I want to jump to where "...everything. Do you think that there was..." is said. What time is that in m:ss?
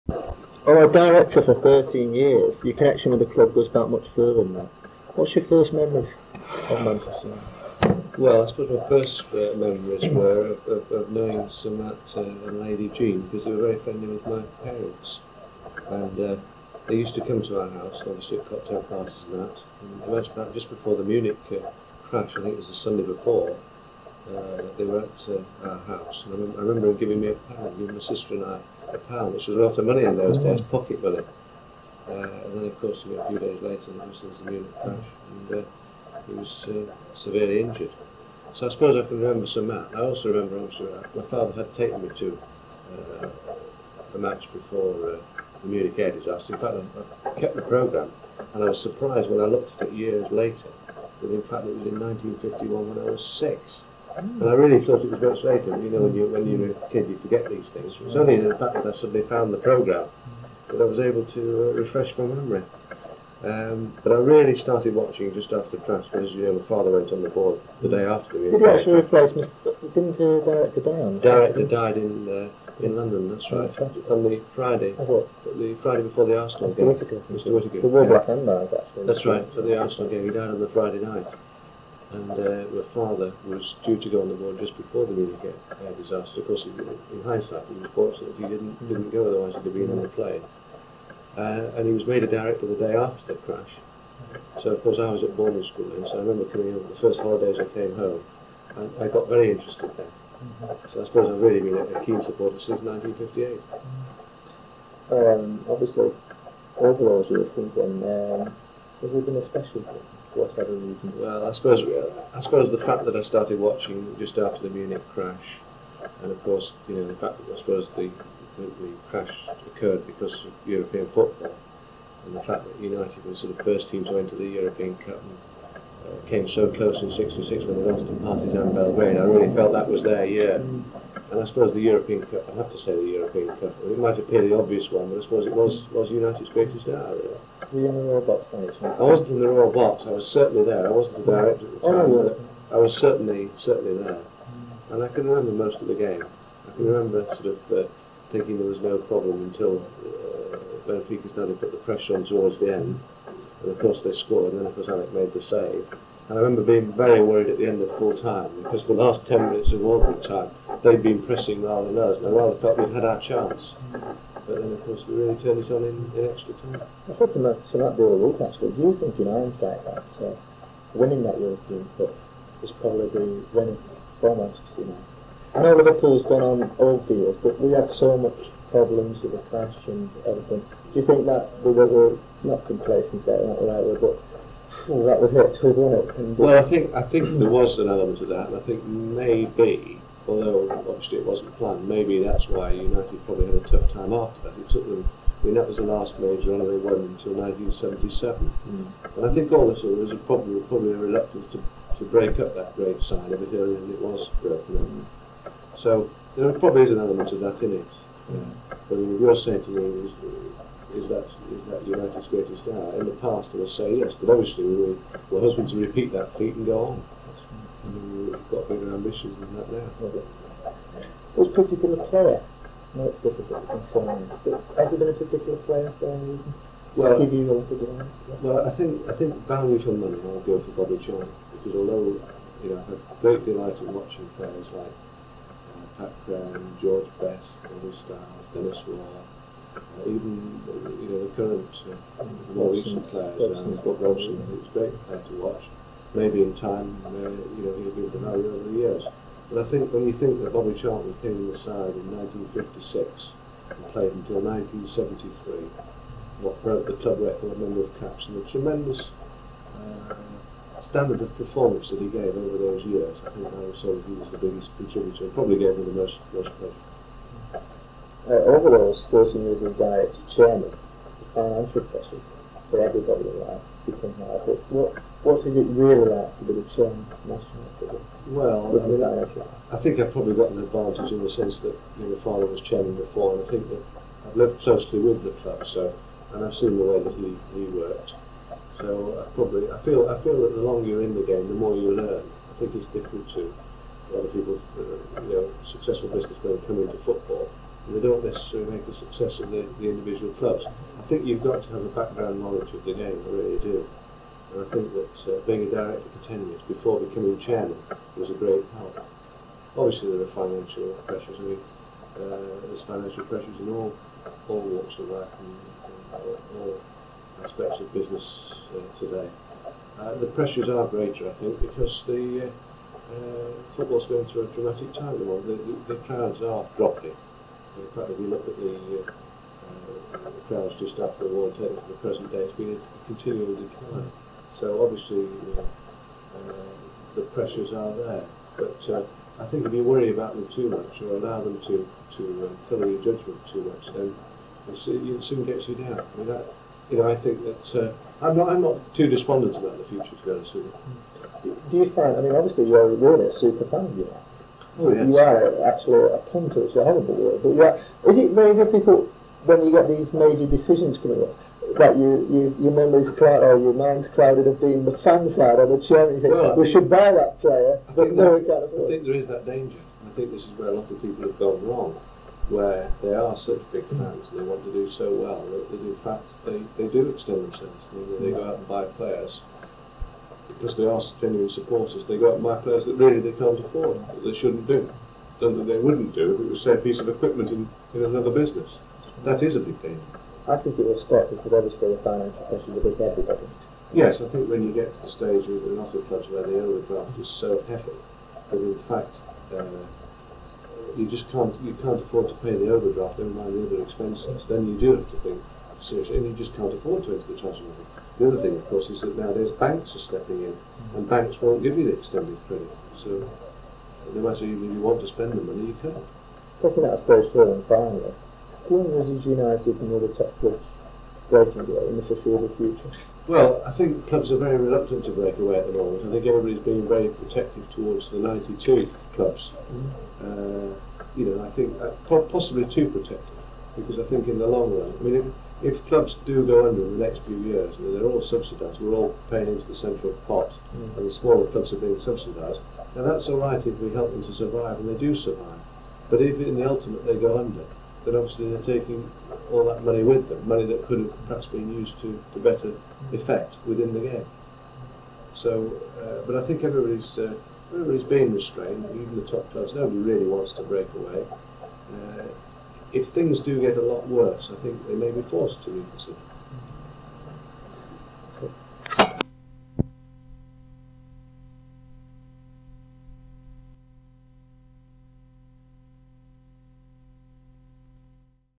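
3:00.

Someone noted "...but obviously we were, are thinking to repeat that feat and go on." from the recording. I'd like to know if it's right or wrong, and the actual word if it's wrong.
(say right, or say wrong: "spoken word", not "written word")
wrong: "hoping", not "thinking".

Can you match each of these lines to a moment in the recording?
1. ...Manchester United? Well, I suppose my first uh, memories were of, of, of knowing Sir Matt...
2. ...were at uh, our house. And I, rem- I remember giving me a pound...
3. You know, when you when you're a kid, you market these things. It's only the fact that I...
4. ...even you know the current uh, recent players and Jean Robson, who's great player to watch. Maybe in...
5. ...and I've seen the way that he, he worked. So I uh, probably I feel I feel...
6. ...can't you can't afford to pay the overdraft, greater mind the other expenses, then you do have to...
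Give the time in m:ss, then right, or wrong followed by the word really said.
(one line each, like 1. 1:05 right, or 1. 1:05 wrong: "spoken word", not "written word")
1. 0:06 right
2. 0:24 right
3. 0:55 wrong: "forget", not "market"
4. 4:00 wrong: "Scott", not "Jean"
5. 4:46 right
6. 6:41 wrong: "never", not "greater".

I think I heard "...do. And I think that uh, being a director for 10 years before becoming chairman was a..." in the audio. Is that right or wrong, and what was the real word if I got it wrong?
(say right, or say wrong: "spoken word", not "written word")
right.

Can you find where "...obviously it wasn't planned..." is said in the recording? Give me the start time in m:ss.
3:10.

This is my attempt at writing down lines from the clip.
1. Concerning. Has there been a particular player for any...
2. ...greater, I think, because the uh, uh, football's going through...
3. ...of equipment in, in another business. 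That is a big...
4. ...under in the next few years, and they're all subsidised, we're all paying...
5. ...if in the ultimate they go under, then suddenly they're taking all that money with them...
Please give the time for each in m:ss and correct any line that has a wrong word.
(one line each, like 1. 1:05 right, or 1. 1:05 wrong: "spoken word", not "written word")
1. 3:43 right
2. 5:20 right
3. 6:26 right
4. 7:16 right
5. 7:26 wrong: "obviously", not "suddenly".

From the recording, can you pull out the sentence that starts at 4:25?
Probably gave him the most most pleasure uh, overdose stationary diet chairman and pressure for everybody alive who can have it.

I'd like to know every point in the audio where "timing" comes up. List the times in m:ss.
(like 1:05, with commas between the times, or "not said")
not said.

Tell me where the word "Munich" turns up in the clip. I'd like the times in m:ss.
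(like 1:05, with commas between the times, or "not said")
0:21, 0:34, 0:45, 1:25, 1:54.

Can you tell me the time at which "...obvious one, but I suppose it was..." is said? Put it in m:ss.
2:14.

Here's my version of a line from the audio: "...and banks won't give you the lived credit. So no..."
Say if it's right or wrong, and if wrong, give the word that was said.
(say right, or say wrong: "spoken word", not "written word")
wrong: "extended", not "lived".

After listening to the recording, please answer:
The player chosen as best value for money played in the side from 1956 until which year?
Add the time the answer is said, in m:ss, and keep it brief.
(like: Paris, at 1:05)
1973, at 4:14.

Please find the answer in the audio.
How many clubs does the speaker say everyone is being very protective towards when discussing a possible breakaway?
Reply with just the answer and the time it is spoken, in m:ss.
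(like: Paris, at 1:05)
92, at 7:08.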